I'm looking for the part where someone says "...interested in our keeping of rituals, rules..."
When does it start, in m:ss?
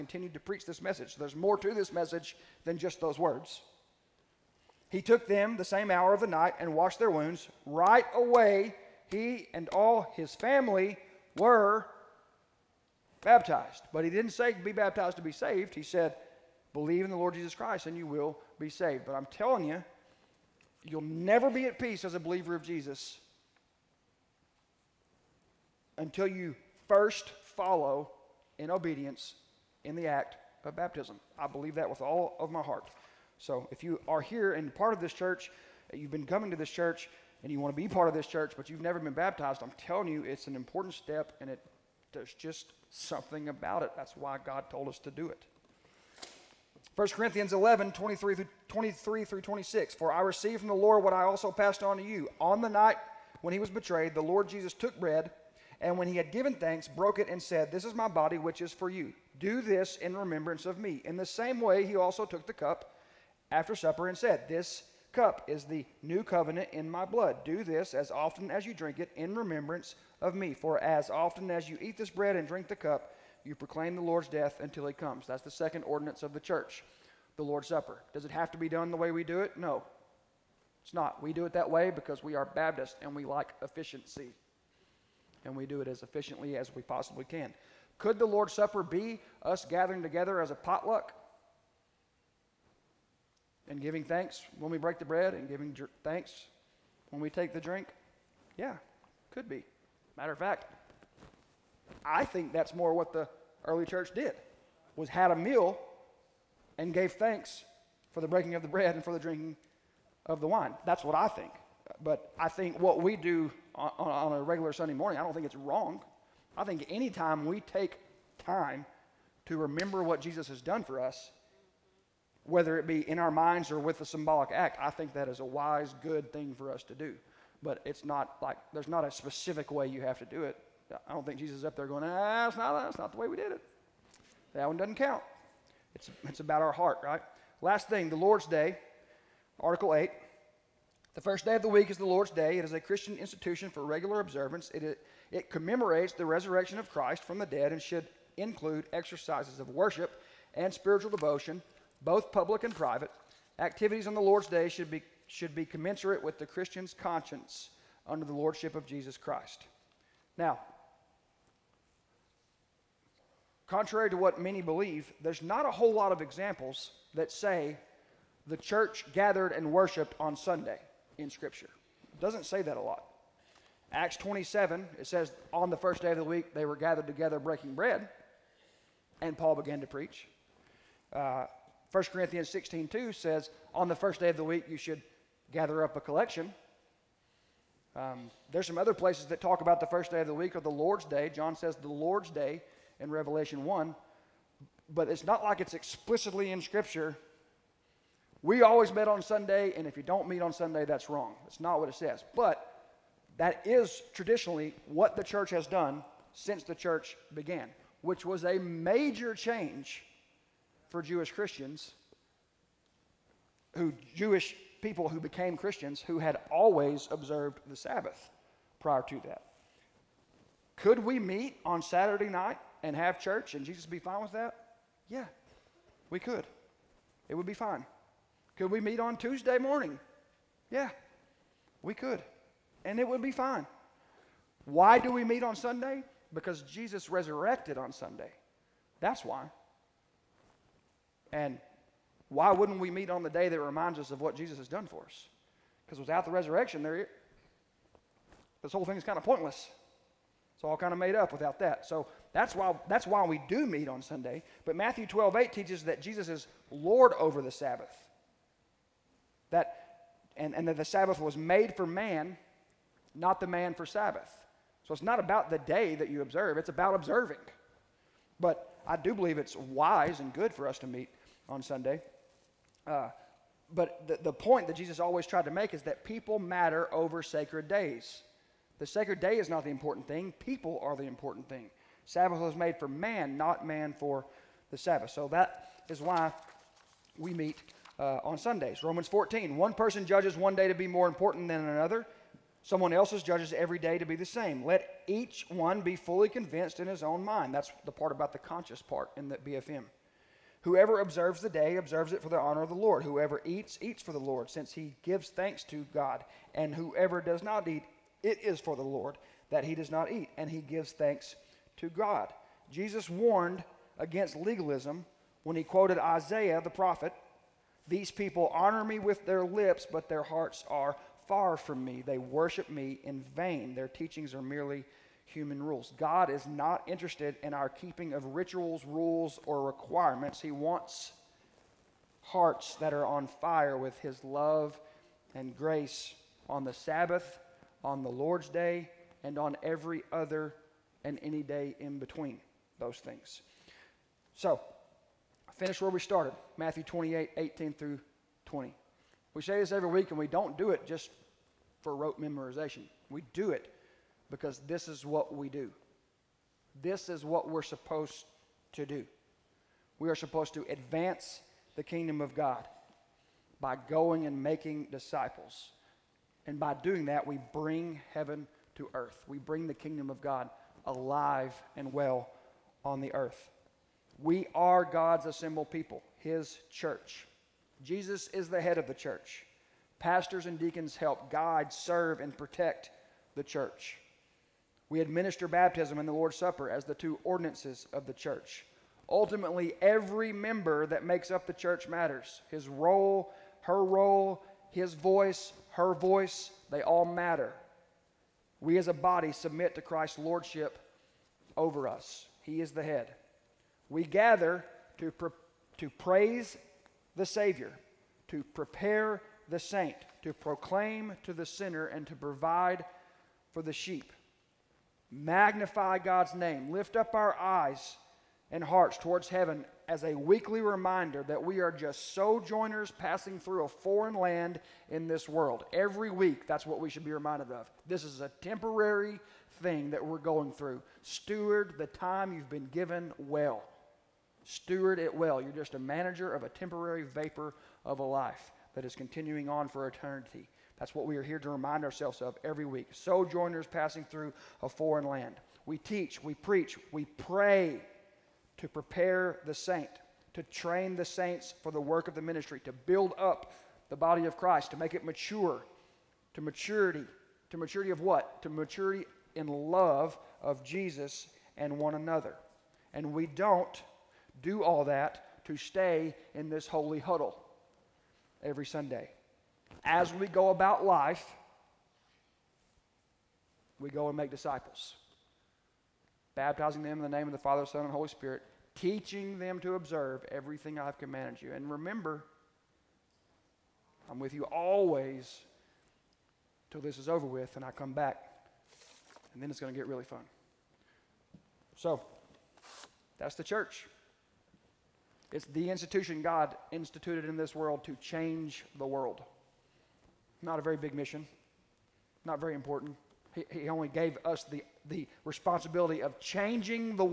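5:26.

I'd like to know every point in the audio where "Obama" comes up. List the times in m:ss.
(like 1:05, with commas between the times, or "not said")
not said.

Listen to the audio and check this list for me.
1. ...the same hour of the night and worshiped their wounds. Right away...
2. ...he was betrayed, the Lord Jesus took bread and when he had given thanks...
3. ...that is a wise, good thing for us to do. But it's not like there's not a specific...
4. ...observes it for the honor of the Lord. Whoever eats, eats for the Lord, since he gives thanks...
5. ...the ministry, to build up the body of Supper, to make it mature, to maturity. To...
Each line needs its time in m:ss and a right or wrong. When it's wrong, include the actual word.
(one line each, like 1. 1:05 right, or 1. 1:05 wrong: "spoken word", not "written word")
1. 0:05 wrong: "washed", not "worshiped"
2. 0:53 right
3. 2:05 right
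4. 5:01 right
5. 7:32 wrong: "Christ", not "Supper".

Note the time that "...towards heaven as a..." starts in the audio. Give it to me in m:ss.
6:58.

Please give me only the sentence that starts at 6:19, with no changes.
Pastors and deacons help guide, serve, and protect the church.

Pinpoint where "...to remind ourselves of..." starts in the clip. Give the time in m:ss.
7:21.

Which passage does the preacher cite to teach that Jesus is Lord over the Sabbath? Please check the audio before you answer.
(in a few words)
Matthew 12:8.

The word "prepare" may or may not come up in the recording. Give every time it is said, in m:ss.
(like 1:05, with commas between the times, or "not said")
6:48, 7:28.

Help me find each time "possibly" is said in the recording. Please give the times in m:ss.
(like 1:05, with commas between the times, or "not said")
1:26.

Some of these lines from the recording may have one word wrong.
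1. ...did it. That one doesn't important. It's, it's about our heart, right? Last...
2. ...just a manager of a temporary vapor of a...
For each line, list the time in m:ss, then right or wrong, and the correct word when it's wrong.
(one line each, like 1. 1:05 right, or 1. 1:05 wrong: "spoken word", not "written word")
1. 2:13 wrong: "count", not "important"
2. 7:15 right.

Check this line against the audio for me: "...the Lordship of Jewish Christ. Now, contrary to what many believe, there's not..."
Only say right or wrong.
wrong.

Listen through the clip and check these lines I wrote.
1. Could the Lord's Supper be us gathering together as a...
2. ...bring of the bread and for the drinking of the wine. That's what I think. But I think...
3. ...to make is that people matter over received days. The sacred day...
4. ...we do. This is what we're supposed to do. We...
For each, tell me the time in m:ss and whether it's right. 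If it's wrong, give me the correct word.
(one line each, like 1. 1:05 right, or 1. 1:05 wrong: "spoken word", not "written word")
1. 1:27 right
2. 1:48 wrong: "breaking", not "bring"
3. 4:35 wrong: "sacred", not "received"
4. 5:55 right.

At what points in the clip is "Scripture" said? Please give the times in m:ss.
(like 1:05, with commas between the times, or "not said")
2:51, 3:16.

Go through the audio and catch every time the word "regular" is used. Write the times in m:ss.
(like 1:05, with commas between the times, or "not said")
1:54, 2:23.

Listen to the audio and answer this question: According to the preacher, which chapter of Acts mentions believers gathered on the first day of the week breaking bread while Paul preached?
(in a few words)
27.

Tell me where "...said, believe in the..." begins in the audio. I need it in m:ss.
0:15.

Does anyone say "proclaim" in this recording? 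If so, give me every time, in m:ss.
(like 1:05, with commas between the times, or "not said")
1:13, 6:50.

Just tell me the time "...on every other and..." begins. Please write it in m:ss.
5:39.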